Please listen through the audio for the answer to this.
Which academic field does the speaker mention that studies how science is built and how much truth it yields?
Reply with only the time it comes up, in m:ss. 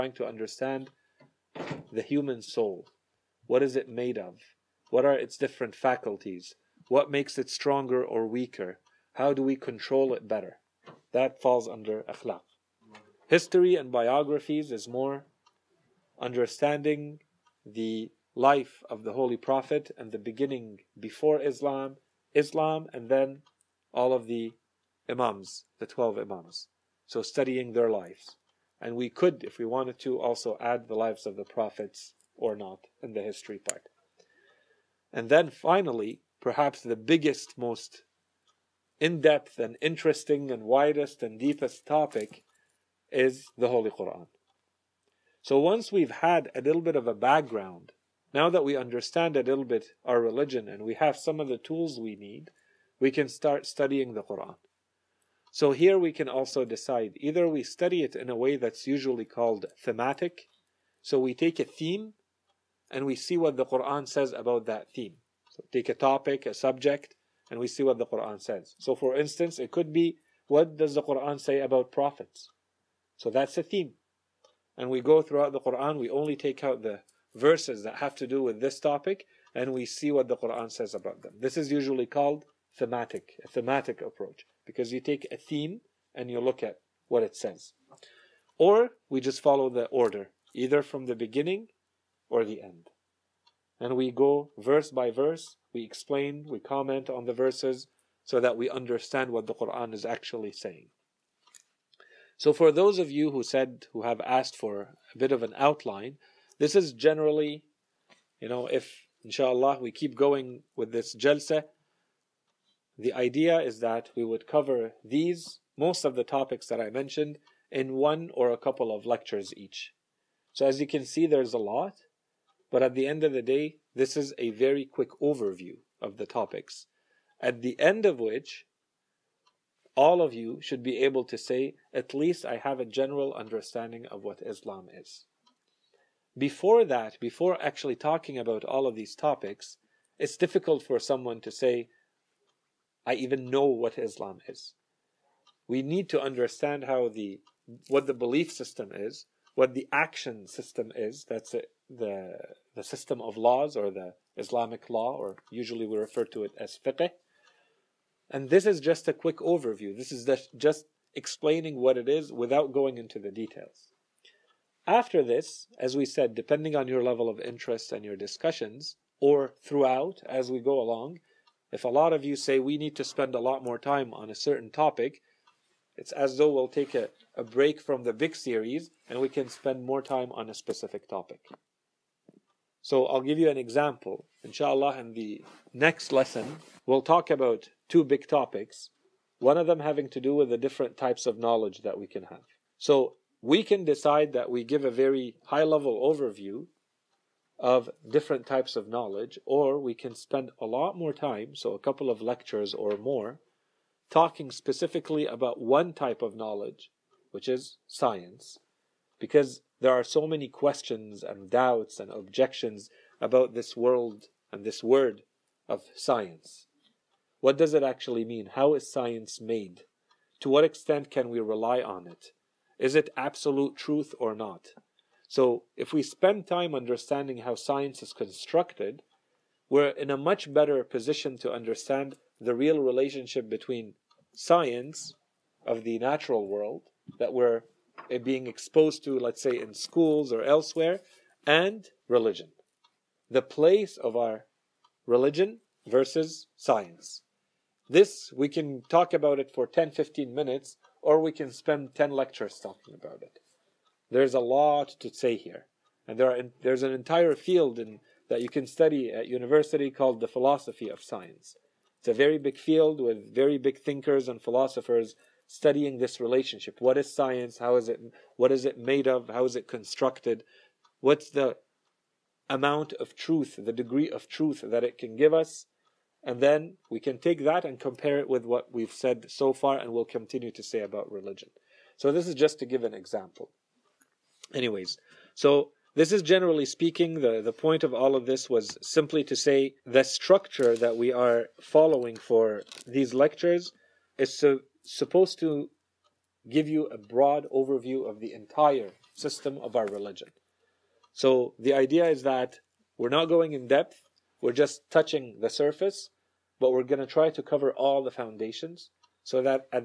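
4:20.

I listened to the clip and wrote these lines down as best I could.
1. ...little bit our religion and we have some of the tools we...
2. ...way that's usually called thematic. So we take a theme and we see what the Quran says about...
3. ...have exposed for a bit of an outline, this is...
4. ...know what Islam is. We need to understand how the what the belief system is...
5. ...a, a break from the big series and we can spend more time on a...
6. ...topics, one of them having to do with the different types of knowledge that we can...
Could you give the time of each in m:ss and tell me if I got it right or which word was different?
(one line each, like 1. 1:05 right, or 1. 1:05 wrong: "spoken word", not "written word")
1. 0:49 right
2. 0:58 right
3. 1:44 wrong: "asked", not "exposed"
4. 2:23 right
5. 2:56 right
6. 3:08 right.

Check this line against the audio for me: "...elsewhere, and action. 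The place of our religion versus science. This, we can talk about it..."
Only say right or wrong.
wrong.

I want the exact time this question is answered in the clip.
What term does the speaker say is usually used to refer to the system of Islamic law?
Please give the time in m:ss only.
2:36.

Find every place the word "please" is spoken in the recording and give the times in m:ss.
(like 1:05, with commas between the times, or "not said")
not said.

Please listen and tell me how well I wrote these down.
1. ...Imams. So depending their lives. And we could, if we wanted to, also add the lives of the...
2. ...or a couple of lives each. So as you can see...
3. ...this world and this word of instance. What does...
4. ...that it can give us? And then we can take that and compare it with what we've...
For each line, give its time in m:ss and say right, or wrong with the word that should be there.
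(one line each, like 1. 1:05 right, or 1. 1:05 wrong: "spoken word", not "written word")
1. 0:26 wrong: "studying", not "depending"
2. 1:58 wrong: "lectures", not "lives"
3. 3:33 wrong: "science", not "instance"
4. 4:34 right.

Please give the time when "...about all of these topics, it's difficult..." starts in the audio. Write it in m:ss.
2:18.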